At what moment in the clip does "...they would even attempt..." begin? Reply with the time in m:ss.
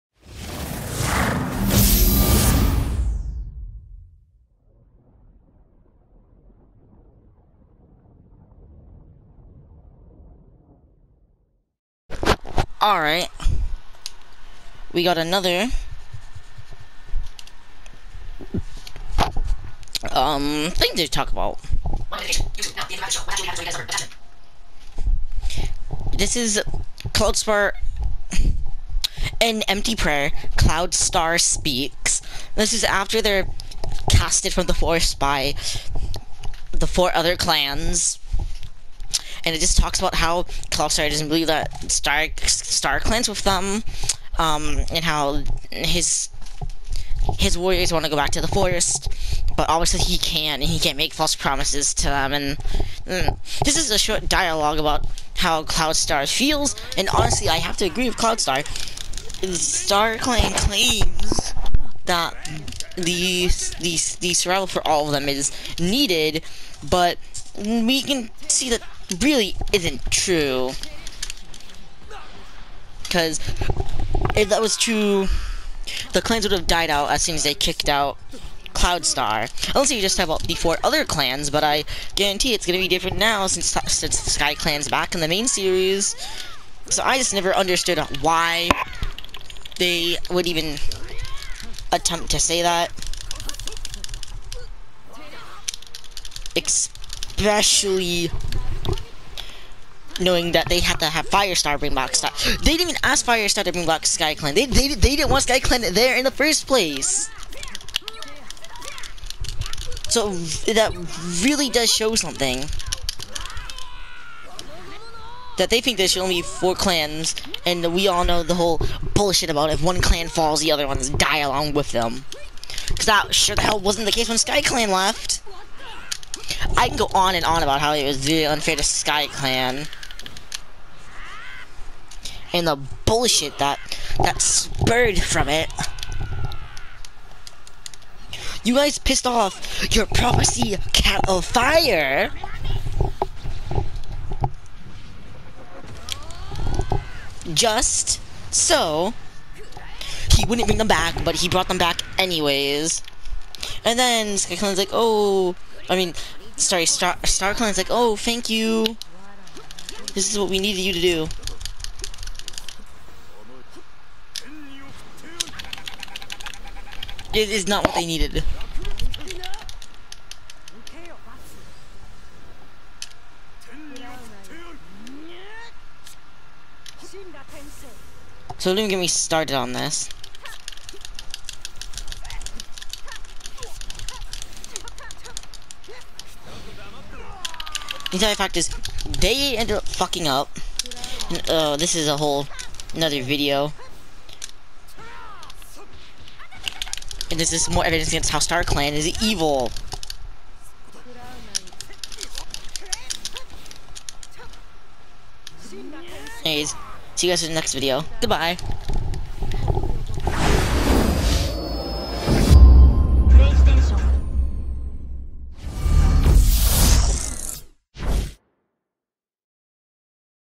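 1:29.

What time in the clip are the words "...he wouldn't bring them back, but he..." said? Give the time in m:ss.
2:30.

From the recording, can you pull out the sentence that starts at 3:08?
The entire fact is, they ended up fucking up.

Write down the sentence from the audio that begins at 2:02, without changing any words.
Because that sure the hell wasn't the case when Sky Clan left.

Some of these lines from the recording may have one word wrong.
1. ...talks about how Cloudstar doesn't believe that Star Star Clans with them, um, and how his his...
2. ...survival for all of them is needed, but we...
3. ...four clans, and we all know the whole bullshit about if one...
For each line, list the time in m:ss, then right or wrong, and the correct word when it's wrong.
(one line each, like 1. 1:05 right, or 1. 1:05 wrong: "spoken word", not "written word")
1. 0:39 right
2. 1:04 right
3. 1:56 right.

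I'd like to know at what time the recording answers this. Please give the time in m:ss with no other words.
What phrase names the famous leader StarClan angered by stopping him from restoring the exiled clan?
2:20.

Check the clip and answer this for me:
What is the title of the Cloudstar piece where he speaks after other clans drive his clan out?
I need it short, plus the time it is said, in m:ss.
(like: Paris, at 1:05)
An Empty Prayer, at 0:29.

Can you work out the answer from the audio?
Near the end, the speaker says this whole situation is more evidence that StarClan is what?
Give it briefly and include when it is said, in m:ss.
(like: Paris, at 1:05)
evil, at 3:19.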